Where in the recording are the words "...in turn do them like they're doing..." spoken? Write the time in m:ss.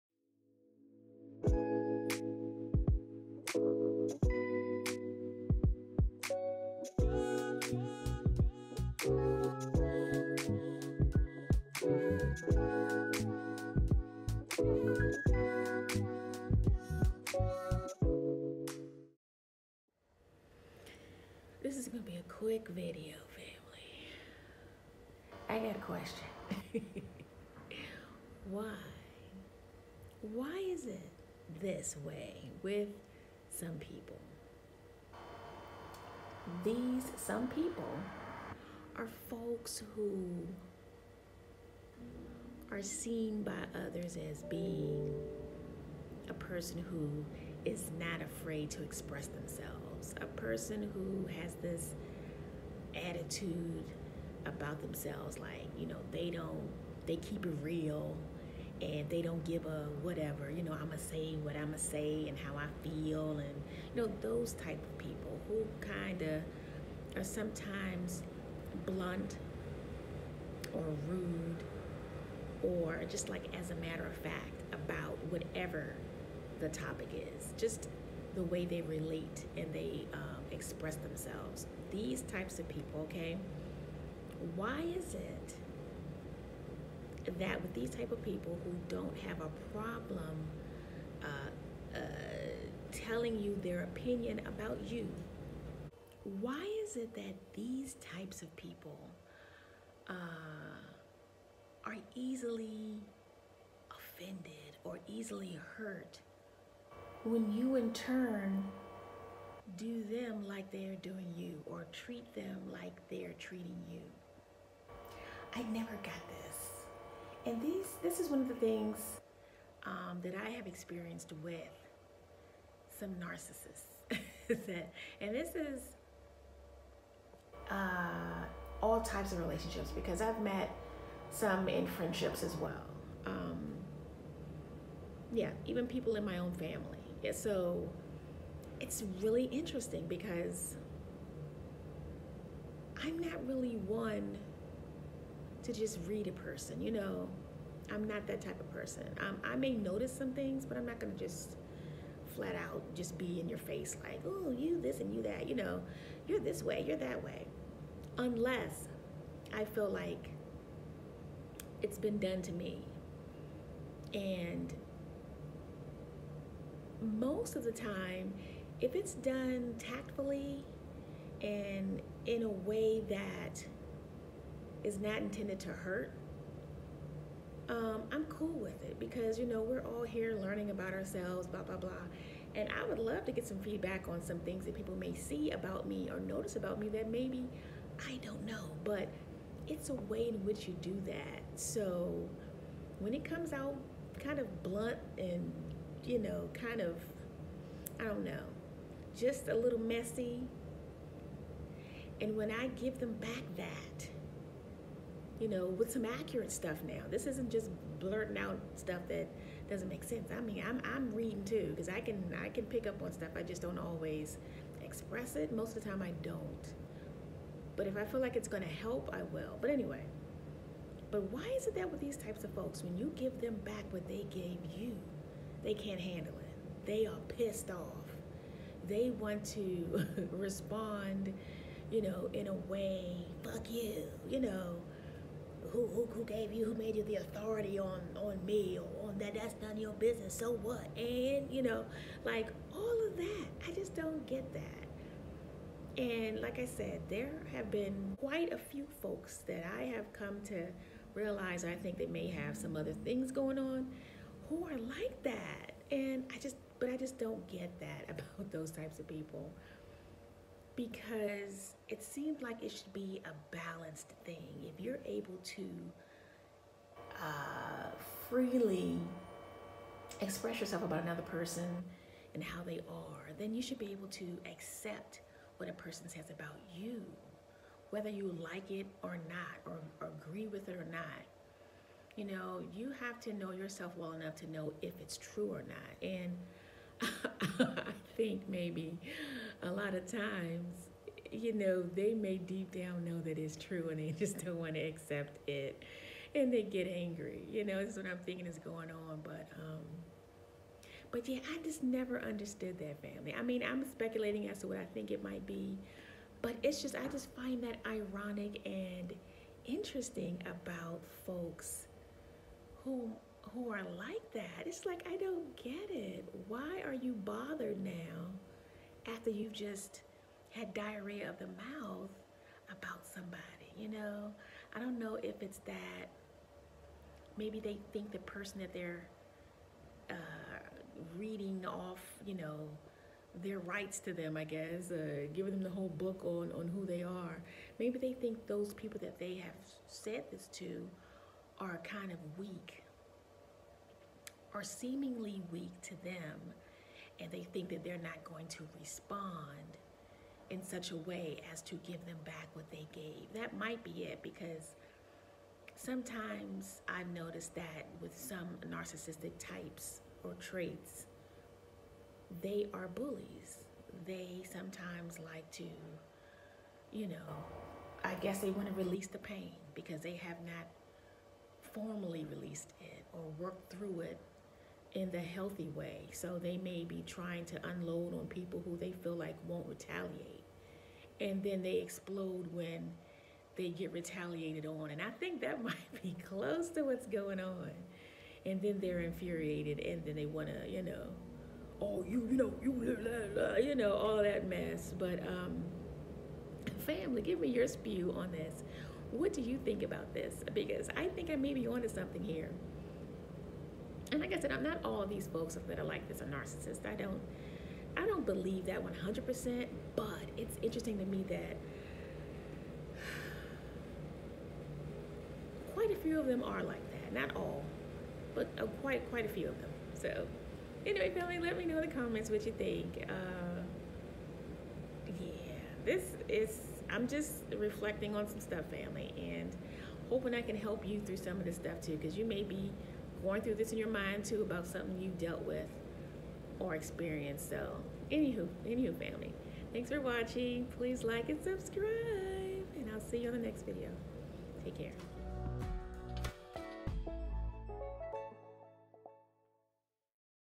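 1:47.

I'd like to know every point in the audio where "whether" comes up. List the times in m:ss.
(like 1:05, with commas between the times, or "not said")
4:37.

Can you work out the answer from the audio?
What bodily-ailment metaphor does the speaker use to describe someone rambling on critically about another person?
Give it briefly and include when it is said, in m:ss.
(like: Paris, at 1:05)
diarrhea of the mouth, at 5:20.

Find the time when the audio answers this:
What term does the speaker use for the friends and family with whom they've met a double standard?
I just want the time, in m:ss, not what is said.
2:03.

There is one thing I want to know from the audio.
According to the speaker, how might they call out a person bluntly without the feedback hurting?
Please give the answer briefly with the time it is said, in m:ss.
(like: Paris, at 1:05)
tactfully, at 2:49.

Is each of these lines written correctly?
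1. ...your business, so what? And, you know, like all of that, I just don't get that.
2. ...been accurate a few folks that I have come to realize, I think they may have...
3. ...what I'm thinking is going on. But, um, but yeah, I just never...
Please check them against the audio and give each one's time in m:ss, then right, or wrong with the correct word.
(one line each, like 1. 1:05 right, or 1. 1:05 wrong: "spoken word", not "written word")
1. 3:59 right
2. 4:07 wrong: "quite", not "accurate"
3. 4:57 right.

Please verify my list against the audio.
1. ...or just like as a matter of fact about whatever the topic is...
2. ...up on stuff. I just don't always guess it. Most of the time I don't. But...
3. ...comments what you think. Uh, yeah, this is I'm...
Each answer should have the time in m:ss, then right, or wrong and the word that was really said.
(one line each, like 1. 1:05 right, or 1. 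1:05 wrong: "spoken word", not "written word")
1. 1:12 right
2. 3:32 wrong: "express", not "guess"
3. 7:01 right.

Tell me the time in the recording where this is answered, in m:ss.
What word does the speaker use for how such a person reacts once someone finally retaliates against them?
6:21.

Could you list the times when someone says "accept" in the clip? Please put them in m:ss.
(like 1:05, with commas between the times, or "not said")
4:34, 4:54.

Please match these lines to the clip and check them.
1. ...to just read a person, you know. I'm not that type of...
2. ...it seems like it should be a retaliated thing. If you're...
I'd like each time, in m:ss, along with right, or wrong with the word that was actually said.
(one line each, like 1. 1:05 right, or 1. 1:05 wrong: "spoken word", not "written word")
1. 2:25 right
2. 4:21 wrong: "balanced", not "retaliated".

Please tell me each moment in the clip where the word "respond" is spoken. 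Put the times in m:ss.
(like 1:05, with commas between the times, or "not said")
3:50, 5:48.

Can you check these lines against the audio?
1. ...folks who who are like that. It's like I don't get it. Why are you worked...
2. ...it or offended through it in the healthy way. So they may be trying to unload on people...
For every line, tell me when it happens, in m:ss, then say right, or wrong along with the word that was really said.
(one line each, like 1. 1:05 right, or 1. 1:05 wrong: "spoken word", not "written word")
1. 5:11 wrong: "bothered", not "worked"
2. 6:12 wrong: "worked", not "offended".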